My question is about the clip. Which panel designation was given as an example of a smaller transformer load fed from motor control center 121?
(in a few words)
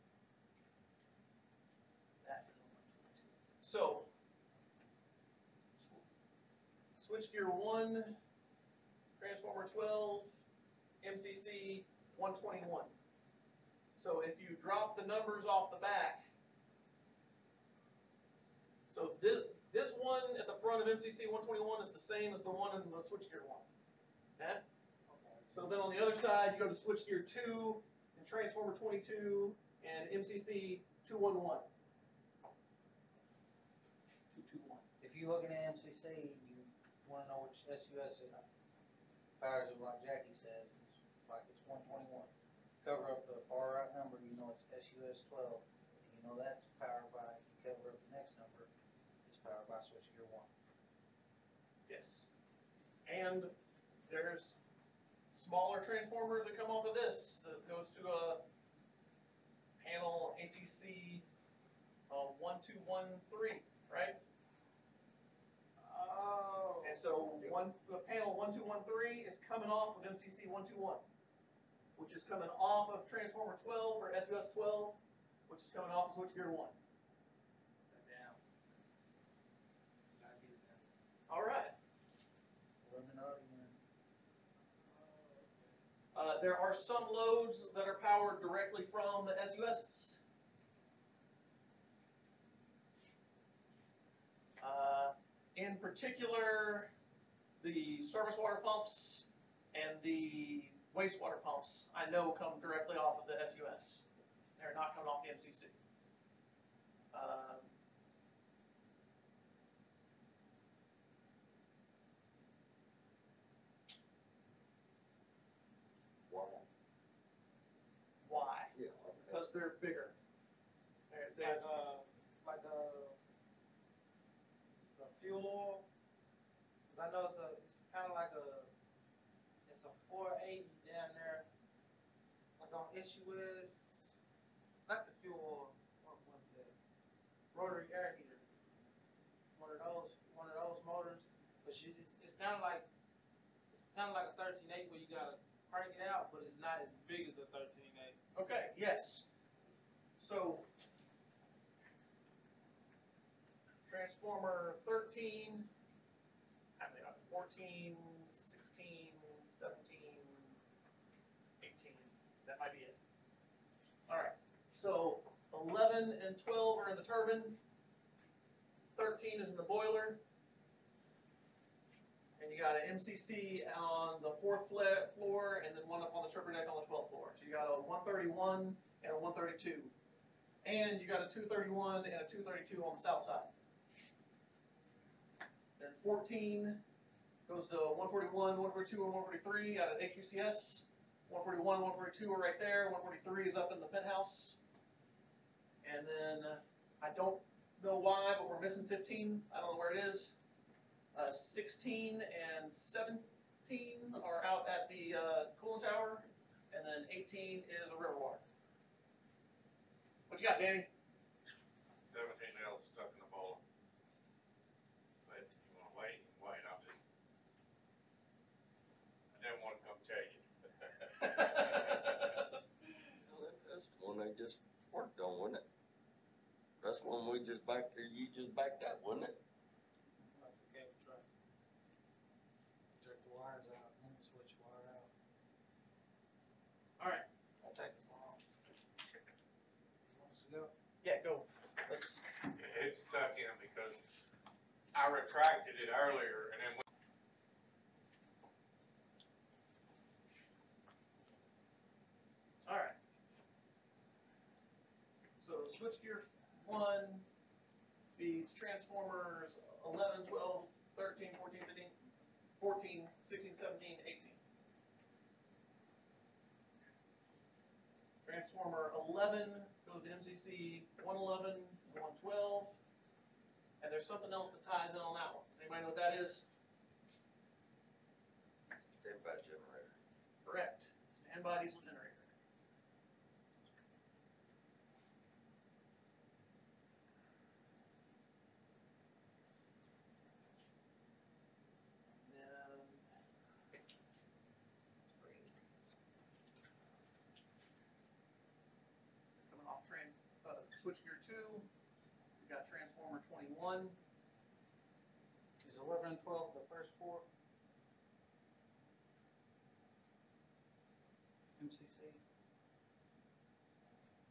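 APC 1213.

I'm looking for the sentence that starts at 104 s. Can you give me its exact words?
They're not coming off the MCC.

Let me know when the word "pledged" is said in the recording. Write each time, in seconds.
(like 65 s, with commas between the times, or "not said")
not said.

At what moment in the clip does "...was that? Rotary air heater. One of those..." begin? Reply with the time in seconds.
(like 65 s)
136 s.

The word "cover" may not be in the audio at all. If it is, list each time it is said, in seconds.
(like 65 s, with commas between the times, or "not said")
42 s, 47 s.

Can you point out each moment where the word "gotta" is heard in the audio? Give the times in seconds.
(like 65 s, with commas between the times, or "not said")
80 s, 145 s.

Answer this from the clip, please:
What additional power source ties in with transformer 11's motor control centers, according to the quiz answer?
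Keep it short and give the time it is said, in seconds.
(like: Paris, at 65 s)
Standby diesel generator, at 281 s.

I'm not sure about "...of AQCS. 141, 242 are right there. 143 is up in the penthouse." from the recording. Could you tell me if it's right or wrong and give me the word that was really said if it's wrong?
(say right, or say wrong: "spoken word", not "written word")
wrong: "142", not "242".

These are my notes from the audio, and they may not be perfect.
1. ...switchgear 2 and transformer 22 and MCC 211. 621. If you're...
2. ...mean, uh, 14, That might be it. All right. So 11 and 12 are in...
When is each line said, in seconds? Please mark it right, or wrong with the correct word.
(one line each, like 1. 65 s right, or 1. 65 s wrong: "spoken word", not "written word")
1. 26 s wrong: "221", not "621"
2. 156 s right.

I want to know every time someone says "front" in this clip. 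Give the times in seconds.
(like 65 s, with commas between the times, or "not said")
20 s.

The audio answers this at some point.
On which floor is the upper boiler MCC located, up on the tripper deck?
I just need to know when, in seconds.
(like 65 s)
176 s.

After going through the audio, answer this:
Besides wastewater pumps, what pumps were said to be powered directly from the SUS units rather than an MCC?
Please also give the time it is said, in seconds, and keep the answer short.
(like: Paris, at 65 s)
Service water pumps, at 97 s.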